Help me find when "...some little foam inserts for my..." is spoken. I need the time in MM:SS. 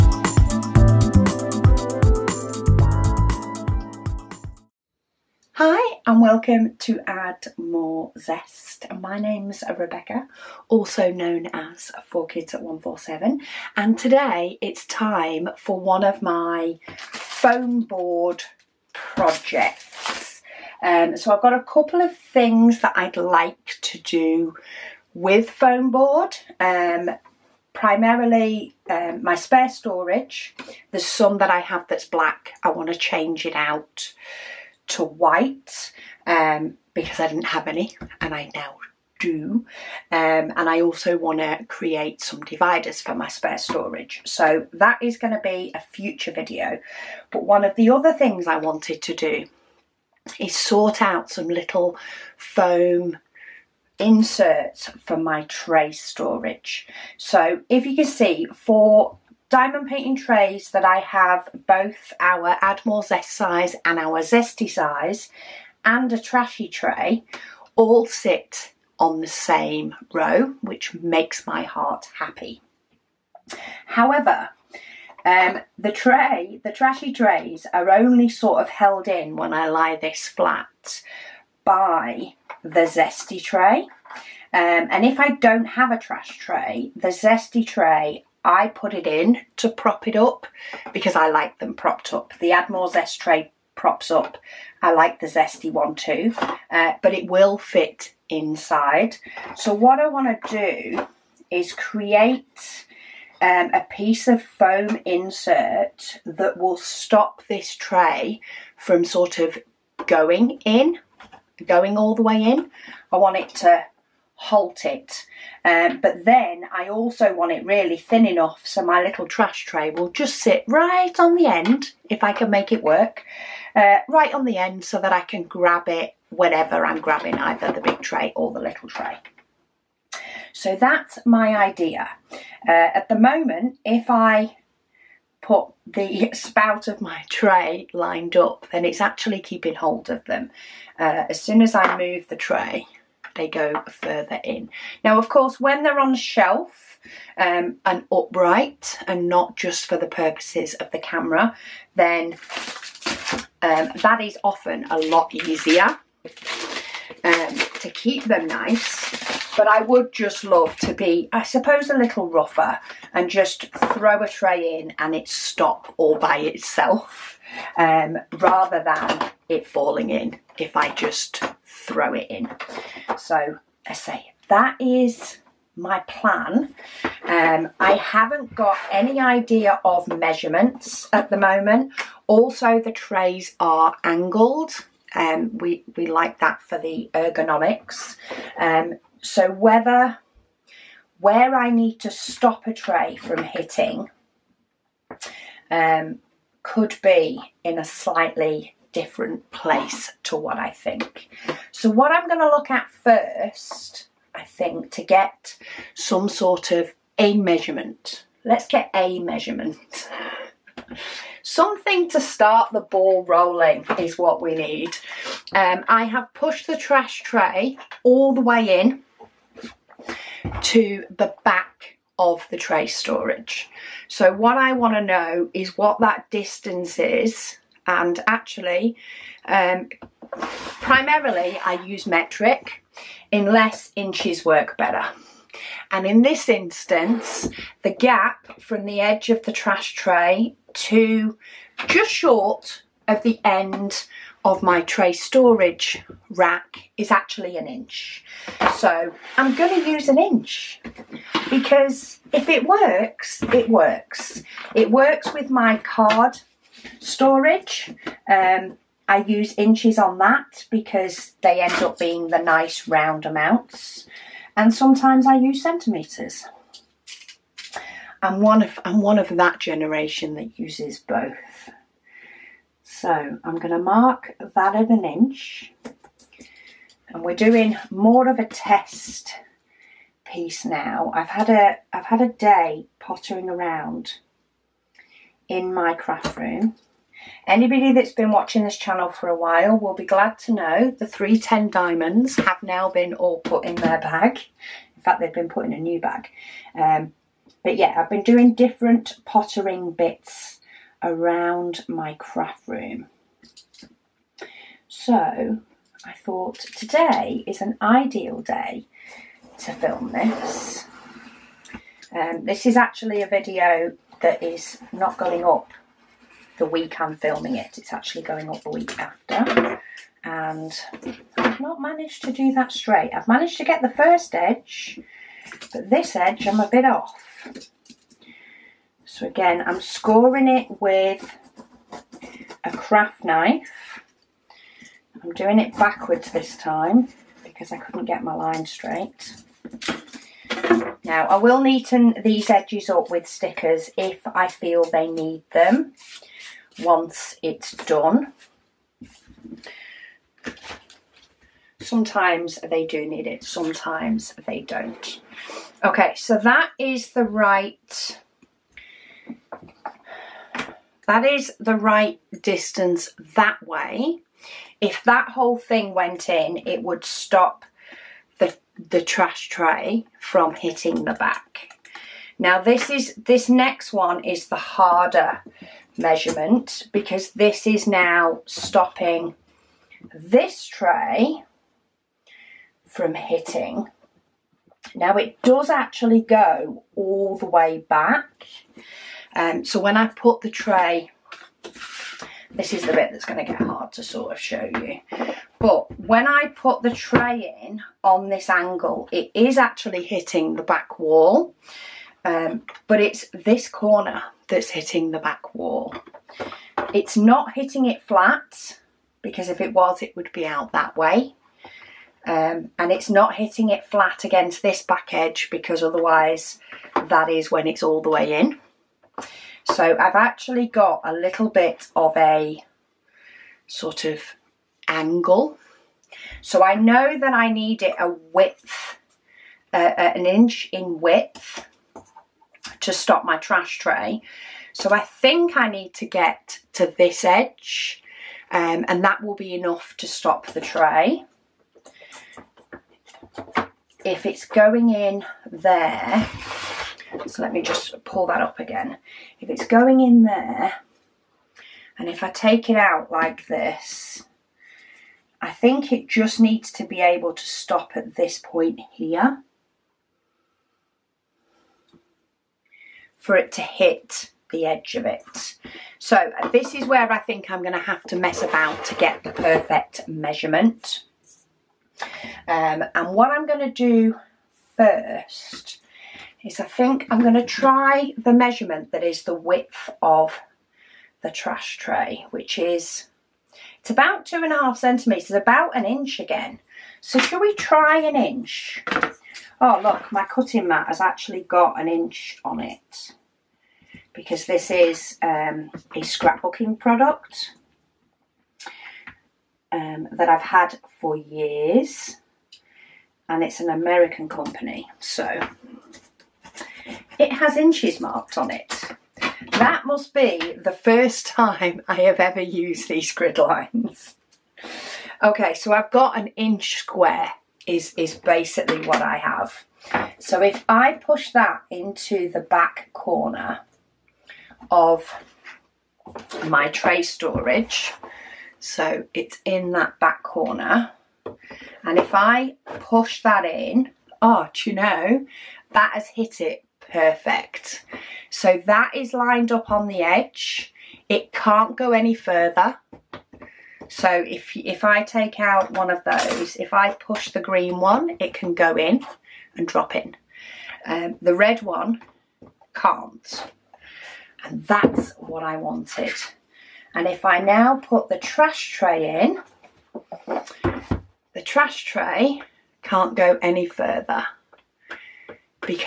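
00:51.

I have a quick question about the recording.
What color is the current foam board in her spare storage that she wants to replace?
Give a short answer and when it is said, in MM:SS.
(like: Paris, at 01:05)
black, at 00:32.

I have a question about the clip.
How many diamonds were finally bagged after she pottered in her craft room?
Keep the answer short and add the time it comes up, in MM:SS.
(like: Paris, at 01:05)
310, at 04:51.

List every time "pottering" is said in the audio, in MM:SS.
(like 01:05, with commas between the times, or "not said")
04:42, 04:59.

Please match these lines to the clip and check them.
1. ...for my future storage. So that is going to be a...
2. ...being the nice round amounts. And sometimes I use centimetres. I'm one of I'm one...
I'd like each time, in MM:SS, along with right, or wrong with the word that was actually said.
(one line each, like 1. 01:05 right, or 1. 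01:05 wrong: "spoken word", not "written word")
1. 00:43 wrong: "spare", not "future"
2. 04:21 right.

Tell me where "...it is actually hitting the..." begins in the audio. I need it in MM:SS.
06:39.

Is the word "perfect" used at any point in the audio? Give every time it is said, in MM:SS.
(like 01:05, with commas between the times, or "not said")
07:49, 08:56.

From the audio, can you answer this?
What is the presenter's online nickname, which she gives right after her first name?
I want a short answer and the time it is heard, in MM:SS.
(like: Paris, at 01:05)
4Kids at 147, at 00:12.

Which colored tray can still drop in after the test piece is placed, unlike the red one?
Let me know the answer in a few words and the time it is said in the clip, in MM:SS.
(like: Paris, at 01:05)
green, at 09:07.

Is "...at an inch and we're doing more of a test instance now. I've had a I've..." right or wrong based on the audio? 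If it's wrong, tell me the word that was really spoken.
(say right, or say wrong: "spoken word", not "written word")
wrong: "piece", not "instance".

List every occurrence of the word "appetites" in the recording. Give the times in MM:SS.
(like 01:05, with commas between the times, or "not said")
not said.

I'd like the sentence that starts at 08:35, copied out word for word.
Okay, so I've got an inch square is, is basically what I have.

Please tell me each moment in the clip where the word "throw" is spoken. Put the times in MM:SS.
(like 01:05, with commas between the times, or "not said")
02:43, 02:51.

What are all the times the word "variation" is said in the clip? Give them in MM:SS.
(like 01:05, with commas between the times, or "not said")
not said.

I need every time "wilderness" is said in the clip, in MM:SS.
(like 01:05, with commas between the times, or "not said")
not said.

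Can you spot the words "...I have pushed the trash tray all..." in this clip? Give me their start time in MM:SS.
03:35.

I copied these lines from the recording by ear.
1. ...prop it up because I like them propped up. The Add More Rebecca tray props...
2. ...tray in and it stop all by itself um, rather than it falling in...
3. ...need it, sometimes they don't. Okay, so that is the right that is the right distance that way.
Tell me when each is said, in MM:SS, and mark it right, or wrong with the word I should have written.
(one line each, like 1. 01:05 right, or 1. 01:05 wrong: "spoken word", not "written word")
1. 01:29 wrong: "Zest", not "Rebecca"
2. 02:44 right
3. 05:53 right.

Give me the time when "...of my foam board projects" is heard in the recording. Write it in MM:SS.
00:16.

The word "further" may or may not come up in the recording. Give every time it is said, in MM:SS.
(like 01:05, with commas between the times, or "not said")
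02:23, 09:02, 09:23.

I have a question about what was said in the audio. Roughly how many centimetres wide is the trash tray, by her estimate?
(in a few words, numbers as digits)
2.5 centimetres.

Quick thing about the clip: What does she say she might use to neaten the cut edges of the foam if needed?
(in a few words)
stickers.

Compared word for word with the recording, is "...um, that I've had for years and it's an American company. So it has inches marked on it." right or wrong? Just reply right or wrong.
right.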